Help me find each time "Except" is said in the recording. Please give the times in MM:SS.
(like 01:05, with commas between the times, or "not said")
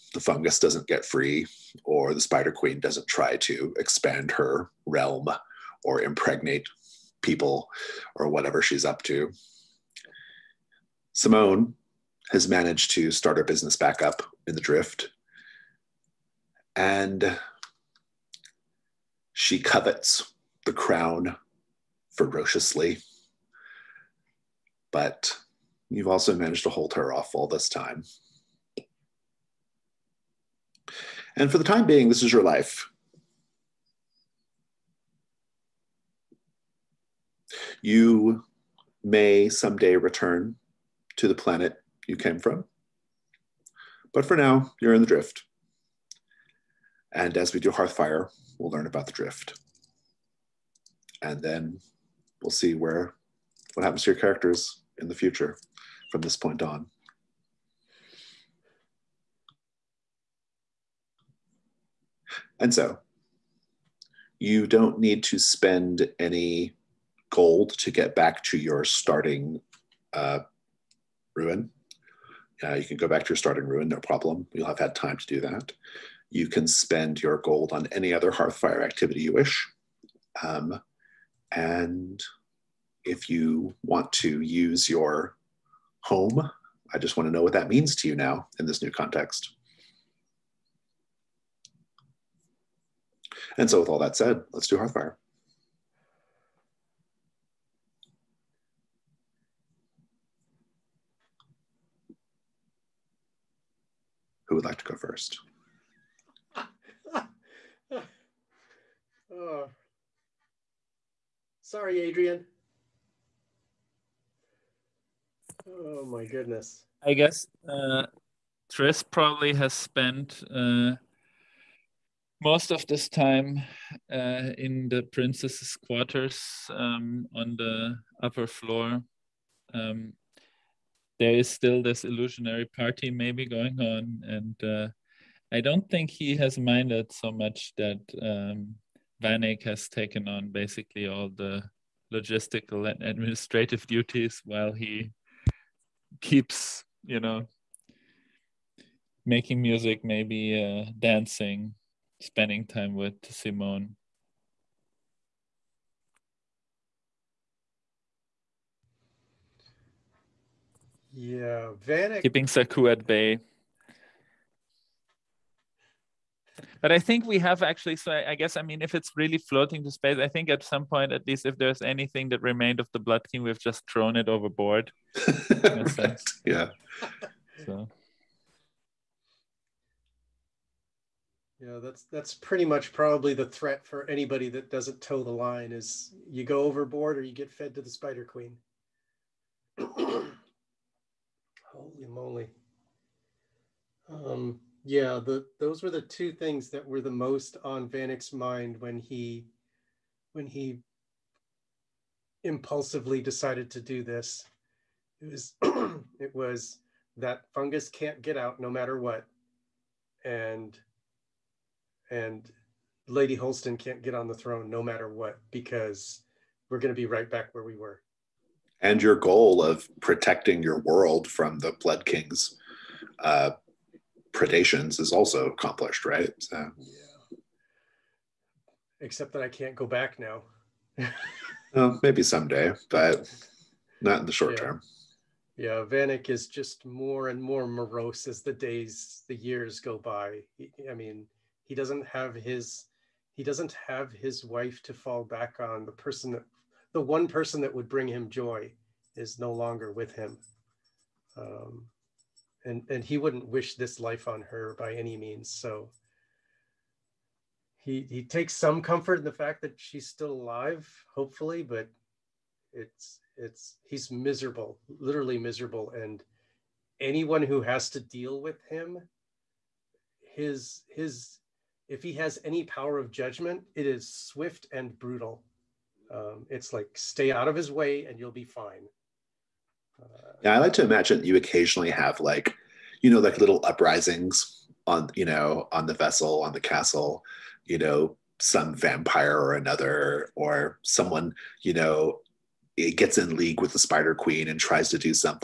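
03:49.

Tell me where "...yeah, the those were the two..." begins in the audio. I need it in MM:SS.
03:14.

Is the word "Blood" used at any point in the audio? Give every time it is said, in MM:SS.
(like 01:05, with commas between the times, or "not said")
02:52, 03:41.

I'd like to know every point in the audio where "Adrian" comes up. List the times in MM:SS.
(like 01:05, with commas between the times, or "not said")
01:52.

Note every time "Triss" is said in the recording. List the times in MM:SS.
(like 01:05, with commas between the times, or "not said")
01:58.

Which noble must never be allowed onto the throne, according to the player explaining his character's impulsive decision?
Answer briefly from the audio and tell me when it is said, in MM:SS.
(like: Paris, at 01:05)
Lady Holston, at 03:33.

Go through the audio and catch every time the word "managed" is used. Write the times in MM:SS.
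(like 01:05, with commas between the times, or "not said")
00:12, 00:26.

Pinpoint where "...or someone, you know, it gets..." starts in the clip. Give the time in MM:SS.
04:50.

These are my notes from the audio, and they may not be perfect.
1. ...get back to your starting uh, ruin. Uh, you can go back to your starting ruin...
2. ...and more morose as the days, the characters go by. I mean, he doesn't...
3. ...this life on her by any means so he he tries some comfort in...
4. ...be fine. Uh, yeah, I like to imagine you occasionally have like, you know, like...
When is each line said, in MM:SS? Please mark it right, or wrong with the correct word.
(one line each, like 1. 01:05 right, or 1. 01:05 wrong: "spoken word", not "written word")
1. 01:07 right
2. 03:57 wrong: "years", not "characters"
3. 04:13 wrong: "takes", not "tries"
4. 04:38 right.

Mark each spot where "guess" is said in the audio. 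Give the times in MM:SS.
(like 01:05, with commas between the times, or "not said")
01:57, 02:48.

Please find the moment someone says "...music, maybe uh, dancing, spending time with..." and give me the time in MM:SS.
02:29.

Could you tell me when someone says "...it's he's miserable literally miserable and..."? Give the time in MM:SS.
04:23.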